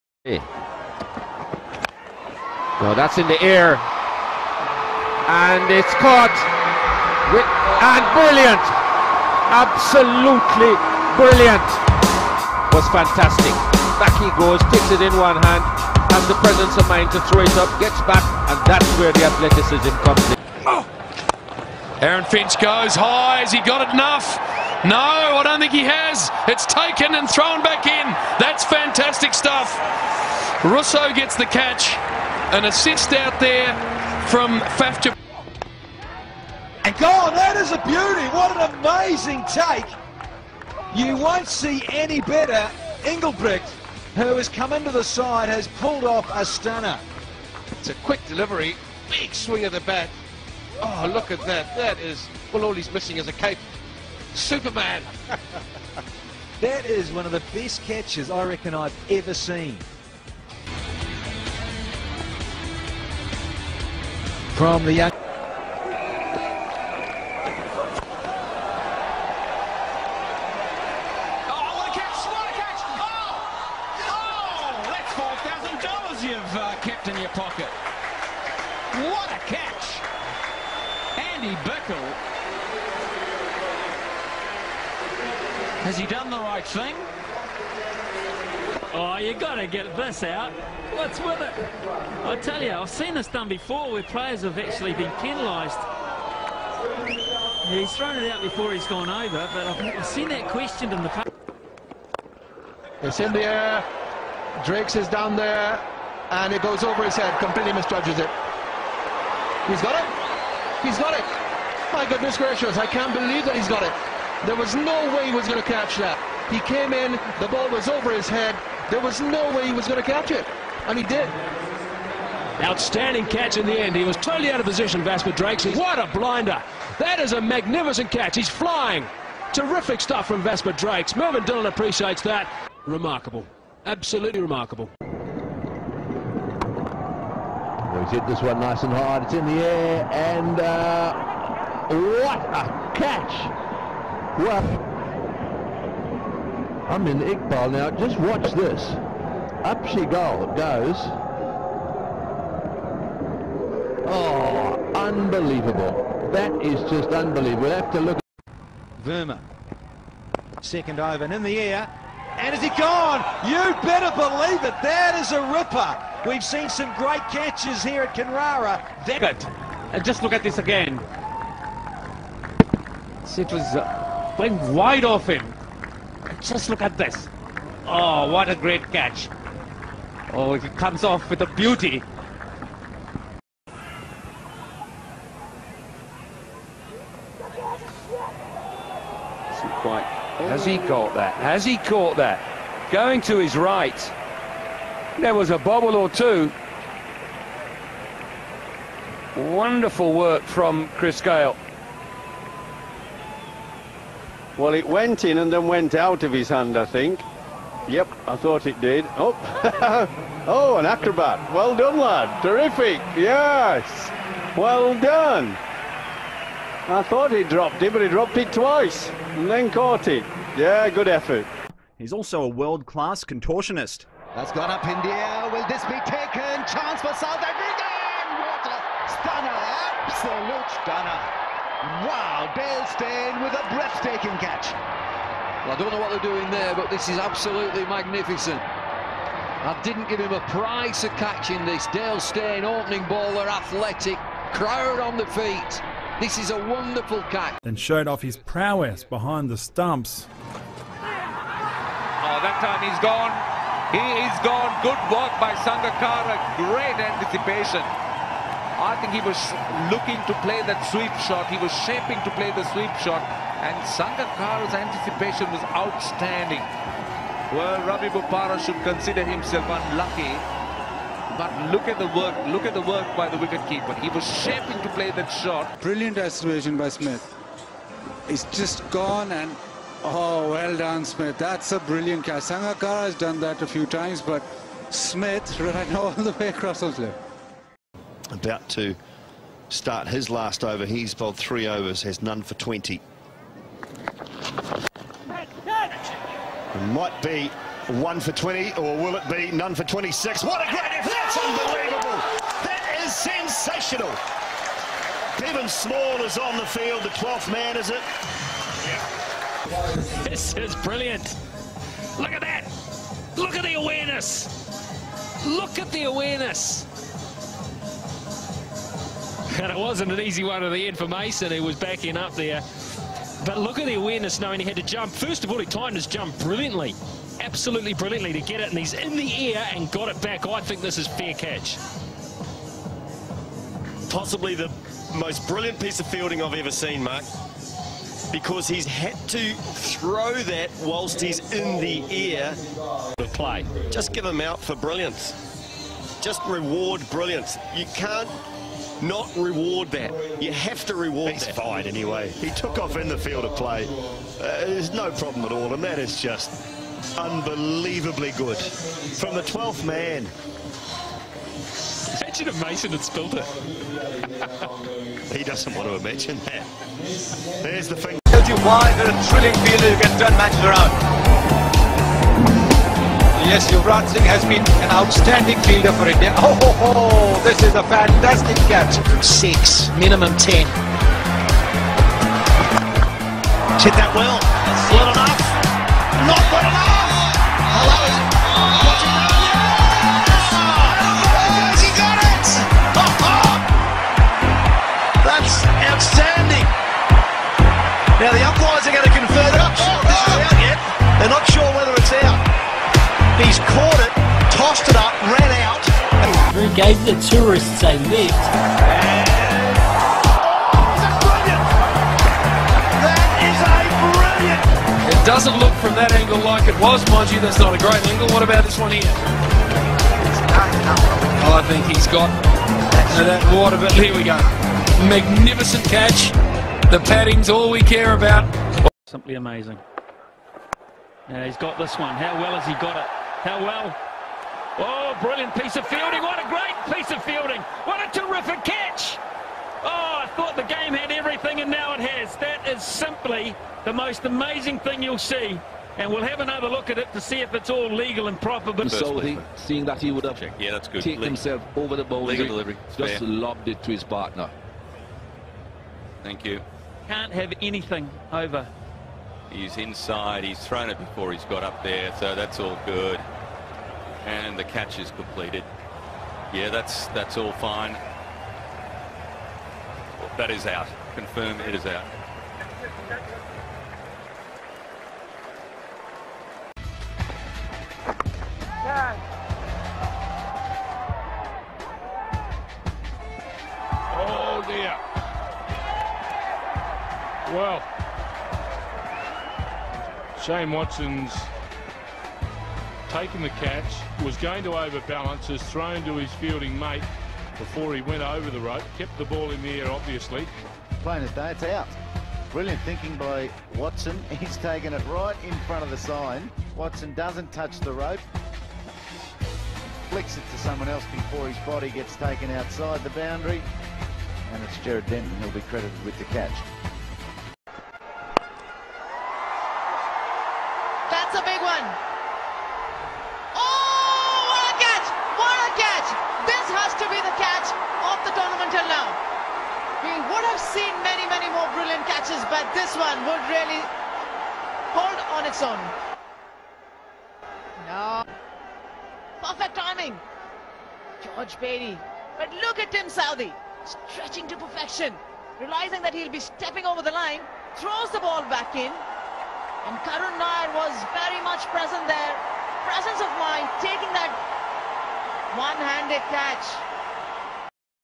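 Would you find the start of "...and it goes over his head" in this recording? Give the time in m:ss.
1:46.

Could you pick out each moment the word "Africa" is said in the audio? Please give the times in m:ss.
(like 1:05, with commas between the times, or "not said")
3:47.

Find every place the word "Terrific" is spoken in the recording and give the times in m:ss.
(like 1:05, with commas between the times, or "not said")
2:09, 3:32.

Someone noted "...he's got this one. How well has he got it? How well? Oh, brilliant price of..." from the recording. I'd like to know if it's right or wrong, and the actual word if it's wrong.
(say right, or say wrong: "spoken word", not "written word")
wrong: "piece", not "price".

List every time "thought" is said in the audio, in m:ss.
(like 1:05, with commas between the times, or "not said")
3:28, 3:37.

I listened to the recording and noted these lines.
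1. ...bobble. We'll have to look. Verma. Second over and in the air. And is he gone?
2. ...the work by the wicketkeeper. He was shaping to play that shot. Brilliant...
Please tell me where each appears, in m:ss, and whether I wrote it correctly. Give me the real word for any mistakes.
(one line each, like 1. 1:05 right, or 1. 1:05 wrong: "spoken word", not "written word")
1. 2:37 wrong: "unbelievable", not "bobble"
2. 4:32 right.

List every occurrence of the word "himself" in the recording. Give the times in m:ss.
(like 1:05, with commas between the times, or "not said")
4:29, 7:31.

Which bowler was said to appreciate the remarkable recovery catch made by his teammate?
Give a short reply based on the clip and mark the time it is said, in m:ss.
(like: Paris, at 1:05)
Mervyn Dillon, at 2:11.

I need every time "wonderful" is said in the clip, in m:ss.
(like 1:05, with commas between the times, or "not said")
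3:19, 4:06.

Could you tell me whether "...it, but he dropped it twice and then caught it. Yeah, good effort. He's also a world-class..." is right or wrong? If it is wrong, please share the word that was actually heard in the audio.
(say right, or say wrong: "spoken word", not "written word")
right.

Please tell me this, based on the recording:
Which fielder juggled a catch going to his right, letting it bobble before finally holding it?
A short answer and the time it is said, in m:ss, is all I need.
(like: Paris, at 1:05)
Chris Gayle, at 3:20.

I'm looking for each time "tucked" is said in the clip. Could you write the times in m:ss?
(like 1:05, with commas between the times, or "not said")
not said.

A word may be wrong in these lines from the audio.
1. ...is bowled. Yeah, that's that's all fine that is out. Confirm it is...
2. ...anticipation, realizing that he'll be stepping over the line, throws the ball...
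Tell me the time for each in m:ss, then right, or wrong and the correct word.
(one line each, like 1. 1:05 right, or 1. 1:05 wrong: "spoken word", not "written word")
1. 7:44 wrong: "completed", not "bowled"
2. 9:04 wrong: "perfection", not "anticipation".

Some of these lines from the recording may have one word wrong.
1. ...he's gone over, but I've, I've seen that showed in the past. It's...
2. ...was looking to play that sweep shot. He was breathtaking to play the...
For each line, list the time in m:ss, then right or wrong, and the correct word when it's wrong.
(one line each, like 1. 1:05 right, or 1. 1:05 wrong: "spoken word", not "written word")
1. 1:38 wrong: "questioned", not "showed"
2. 4:19 wrong: "shaping", not "breathtaking".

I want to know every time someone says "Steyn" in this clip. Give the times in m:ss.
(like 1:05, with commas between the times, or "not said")
3:52, 4:02.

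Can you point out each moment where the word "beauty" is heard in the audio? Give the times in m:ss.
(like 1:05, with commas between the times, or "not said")
0:37, 3:01.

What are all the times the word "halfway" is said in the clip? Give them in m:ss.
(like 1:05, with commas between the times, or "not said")
not said.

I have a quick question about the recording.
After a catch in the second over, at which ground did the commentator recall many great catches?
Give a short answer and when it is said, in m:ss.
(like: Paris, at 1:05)
Canberra, at 2:48.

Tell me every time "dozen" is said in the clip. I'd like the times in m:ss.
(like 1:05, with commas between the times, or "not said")
not said.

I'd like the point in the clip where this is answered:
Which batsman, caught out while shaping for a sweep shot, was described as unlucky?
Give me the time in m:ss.
4:27.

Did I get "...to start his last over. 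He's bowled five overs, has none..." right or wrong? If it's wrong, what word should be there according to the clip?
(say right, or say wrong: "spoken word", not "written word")
wrong: "three", not "five".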